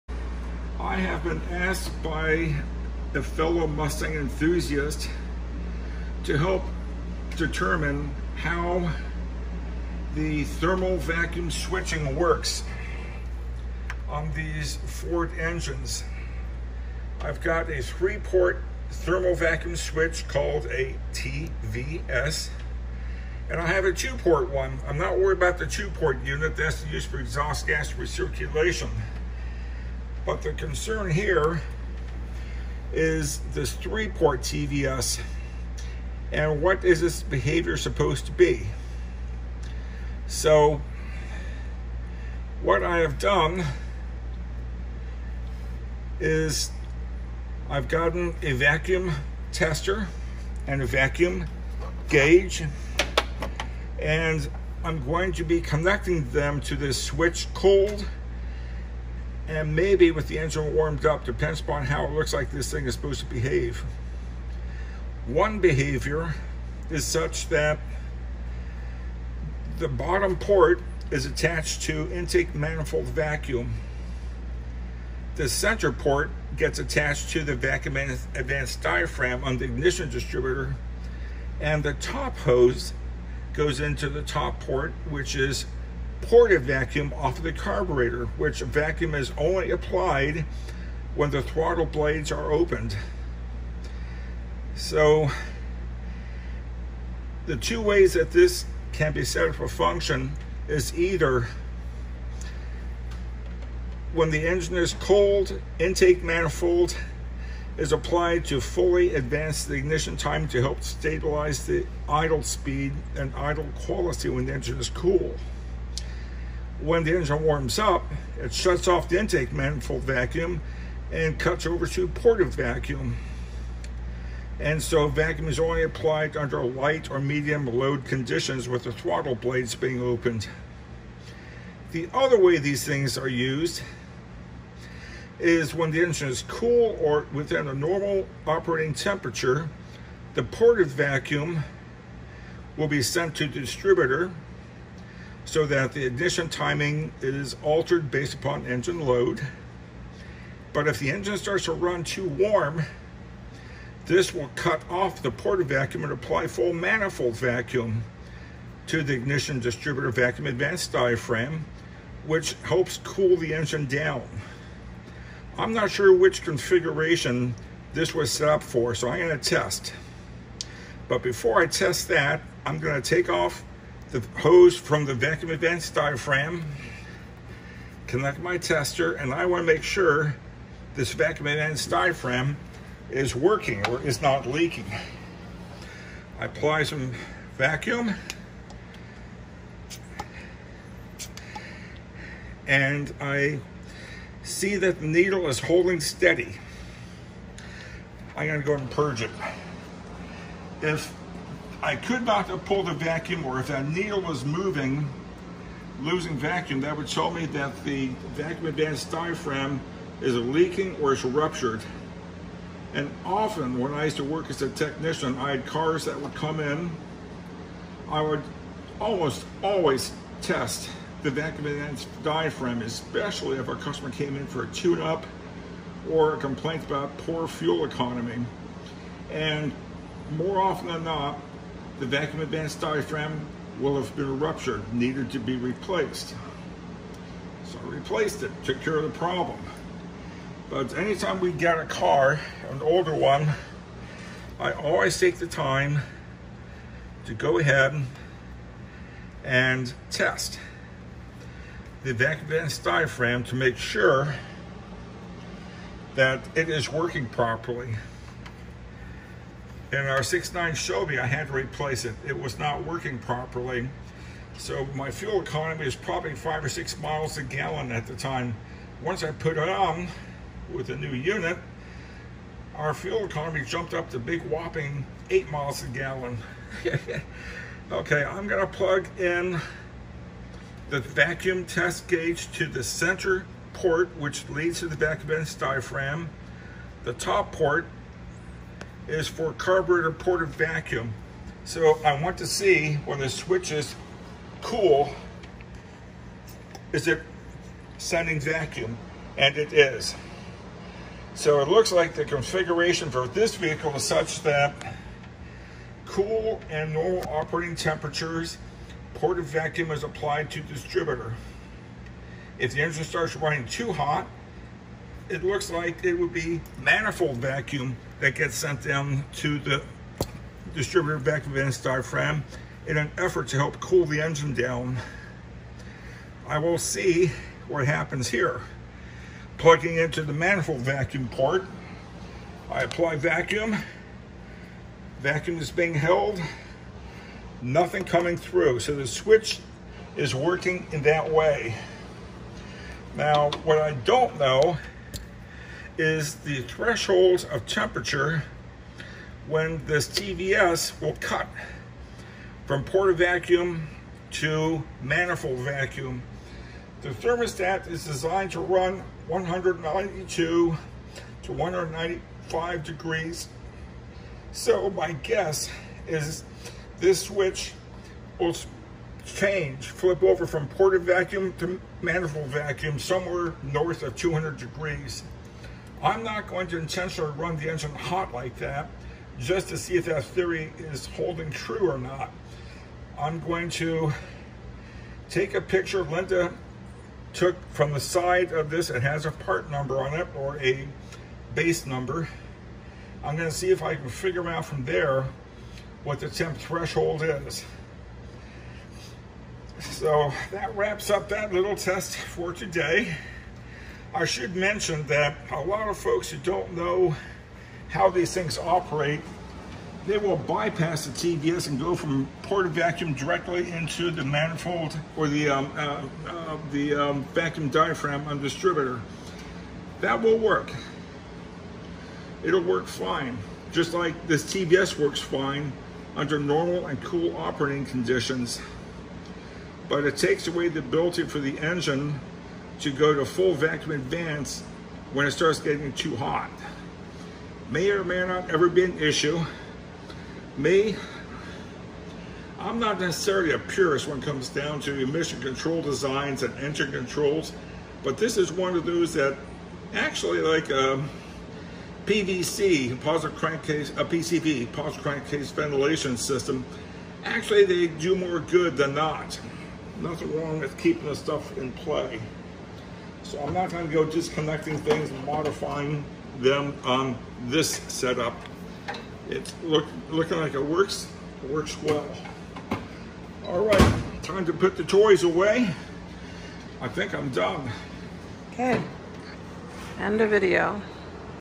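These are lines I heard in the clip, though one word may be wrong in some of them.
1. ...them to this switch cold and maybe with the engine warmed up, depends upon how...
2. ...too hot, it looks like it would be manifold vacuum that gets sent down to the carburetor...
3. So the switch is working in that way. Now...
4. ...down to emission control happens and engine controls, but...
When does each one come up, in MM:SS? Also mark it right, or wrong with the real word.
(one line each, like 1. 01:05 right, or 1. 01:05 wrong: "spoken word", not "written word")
1. 00:56 right
2. 05:13 wrong: "distributor", not "carburetor"
3. 05:38 right
4. 07:24 wrong: "designs", not "happens".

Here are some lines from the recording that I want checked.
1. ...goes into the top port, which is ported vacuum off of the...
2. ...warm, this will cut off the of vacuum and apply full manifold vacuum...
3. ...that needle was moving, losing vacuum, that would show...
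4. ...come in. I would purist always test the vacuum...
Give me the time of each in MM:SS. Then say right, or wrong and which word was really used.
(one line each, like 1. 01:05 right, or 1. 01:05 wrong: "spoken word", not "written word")
1. 01:23 right
2. 02:32 right
3. 03:23 right
4. 03:36 wrong: "almost", not "purist".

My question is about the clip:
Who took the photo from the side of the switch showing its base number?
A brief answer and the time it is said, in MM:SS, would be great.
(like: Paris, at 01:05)
Linda, at 06:26.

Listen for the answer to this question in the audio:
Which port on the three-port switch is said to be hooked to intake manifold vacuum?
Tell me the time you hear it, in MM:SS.
01:09.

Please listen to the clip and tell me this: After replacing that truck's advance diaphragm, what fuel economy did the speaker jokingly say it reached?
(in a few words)
8 miles a gallon.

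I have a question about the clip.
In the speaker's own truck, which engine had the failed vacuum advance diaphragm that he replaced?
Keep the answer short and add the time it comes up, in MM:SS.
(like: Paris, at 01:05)
6.9, at 04:20.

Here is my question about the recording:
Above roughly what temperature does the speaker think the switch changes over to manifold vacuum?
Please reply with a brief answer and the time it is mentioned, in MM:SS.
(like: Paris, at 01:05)
200 degrees, at 06:14.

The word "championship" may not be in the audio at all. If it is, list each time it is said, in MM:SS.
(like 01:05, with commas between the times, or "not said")
not said.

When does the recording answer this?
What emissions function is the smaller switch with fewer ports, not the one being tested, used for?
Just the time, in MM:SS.
00:27.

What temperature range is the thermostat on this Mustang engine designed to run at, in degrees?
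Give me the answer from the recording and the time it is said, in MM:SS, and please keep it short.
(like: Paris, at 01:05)
192 to 195 degrees, at 05:59.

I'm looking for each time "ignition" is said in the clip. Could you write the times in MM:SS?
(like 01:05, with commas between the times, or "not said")
01:19, 01:49, 02:26, 02:39.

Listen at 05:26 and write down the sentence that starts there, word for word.
I will see what happens here.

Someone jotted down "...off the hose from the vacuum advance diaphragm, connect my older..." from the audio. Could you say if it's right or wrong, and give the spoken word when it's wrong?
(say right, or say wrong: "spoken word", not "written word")
wrong: "tester", not "older".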